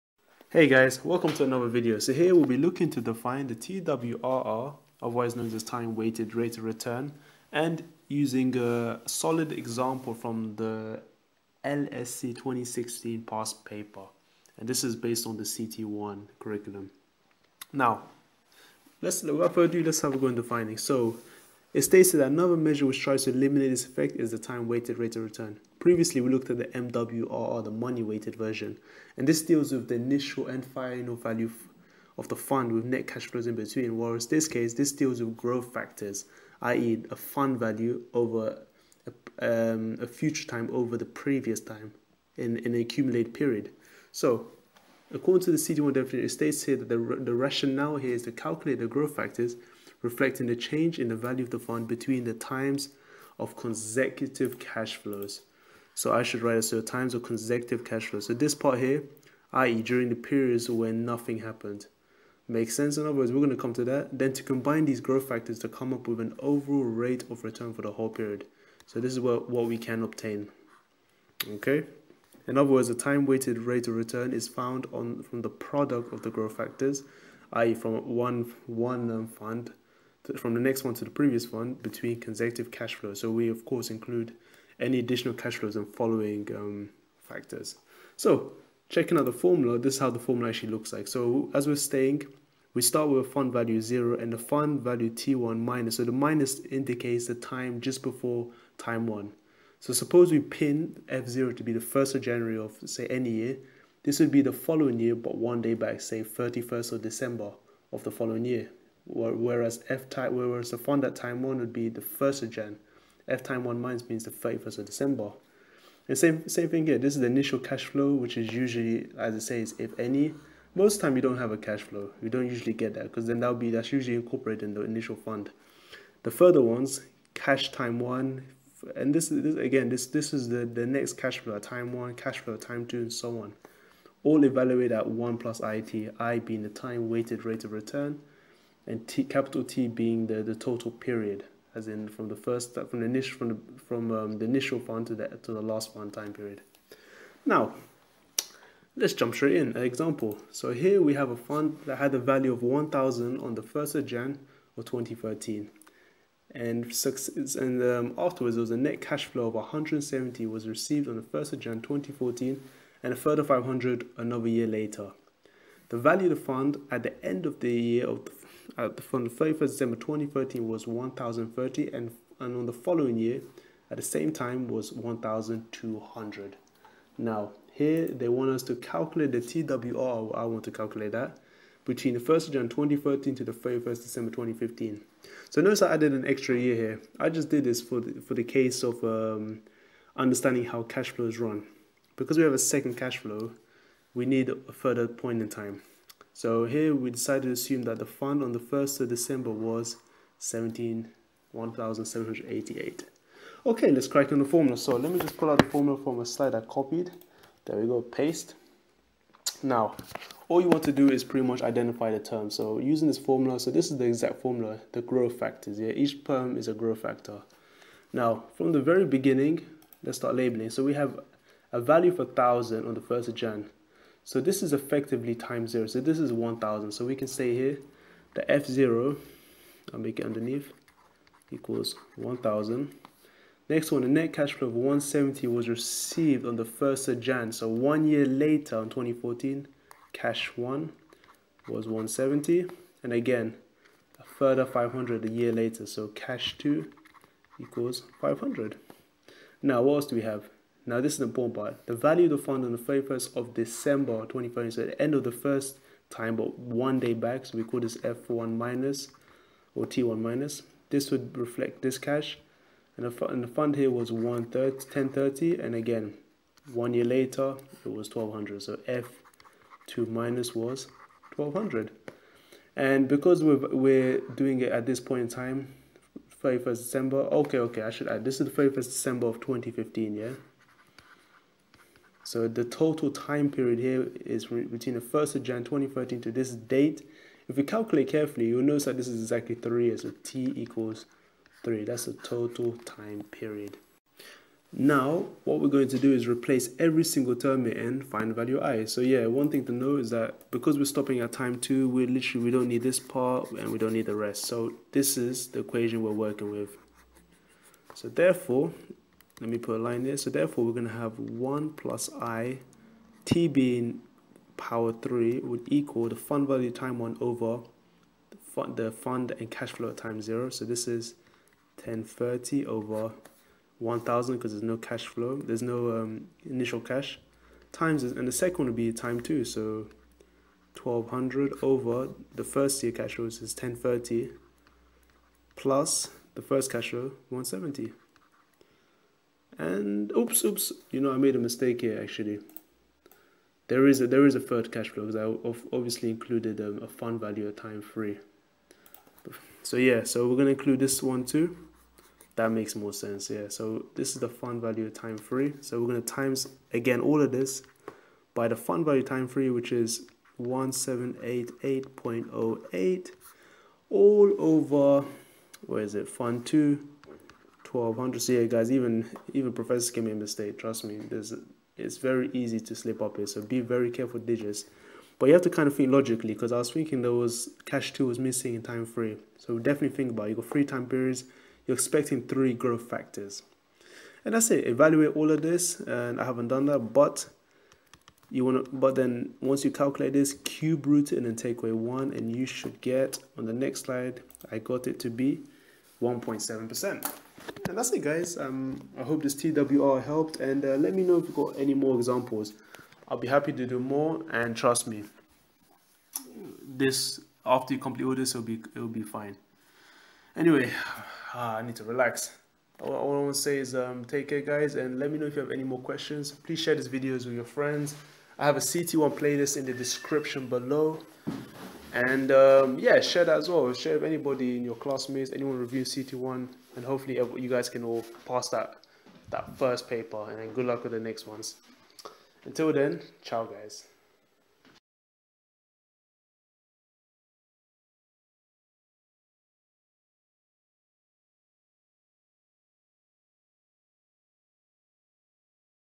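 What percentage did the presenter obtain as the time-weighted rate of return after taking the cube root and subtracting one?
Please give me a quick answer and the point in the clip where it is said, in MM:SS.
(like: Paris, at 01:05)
1.7%, at 06:36.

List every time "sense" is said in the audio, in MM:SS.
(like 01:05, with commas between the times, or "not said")
01:02, 05:52.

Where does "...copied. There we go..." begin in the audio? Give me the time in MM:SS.
03:26.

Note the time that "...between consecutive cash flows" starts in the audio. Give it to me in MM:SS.
01:21.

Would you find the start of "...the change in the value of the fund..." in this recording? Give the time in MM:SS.
00:50.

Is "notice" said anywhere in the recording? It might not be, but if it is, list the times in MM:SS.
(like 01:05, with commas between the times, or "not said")
03:05, 04:48.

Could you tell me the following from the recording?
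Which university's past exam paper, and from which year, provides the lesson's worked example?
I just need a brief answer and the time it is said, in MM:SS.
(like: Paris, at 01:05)
LSE 2016, at 00:11.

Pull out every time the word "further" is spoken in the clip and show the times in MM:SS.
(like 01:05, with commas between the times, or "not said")
00:19, 02:06, 02:43, 03:14, 04:04.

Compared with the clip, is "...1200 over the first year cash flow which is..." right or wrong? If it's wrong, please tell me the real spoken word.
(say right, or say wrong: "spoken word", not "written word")
right.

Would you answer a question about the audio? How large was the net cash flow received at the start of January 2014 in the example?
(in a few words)
170.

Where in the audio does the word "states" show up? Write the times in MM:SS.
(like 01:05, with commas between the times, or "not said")
00:21, 00:46.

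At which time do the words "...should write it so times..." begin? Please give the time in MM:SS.
00:56.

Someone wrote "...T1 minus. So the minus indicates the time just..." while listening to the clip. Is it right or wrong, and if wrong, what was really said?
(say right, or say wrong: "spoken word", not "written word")
right.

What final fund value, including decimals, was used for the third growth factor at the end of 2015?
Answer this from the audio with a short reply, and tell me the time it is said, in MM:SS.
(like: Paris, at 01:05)
1788.08, at 06:00.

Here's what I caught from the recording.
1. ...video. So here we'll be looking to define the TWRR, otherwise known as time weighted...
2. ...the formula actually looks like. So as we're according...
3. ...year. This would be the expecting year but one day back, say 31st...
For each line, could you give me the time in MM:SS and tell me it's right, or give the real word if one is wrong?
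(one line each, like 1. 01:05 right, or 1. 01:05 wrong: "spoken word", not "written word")
1. 00:01 right
2. 01:30 wrong: "staying", not "according"
3. 01:43 wrong: "following", not "expecting".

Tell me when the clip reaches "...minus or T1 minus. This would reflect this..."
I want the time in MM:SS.
04:18.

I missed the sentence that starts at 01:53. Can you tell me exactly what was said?
F time one minus means the 31st of December.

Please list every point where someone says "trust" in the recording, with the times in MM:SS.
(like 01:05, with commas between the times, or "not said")
06:10, 06:44.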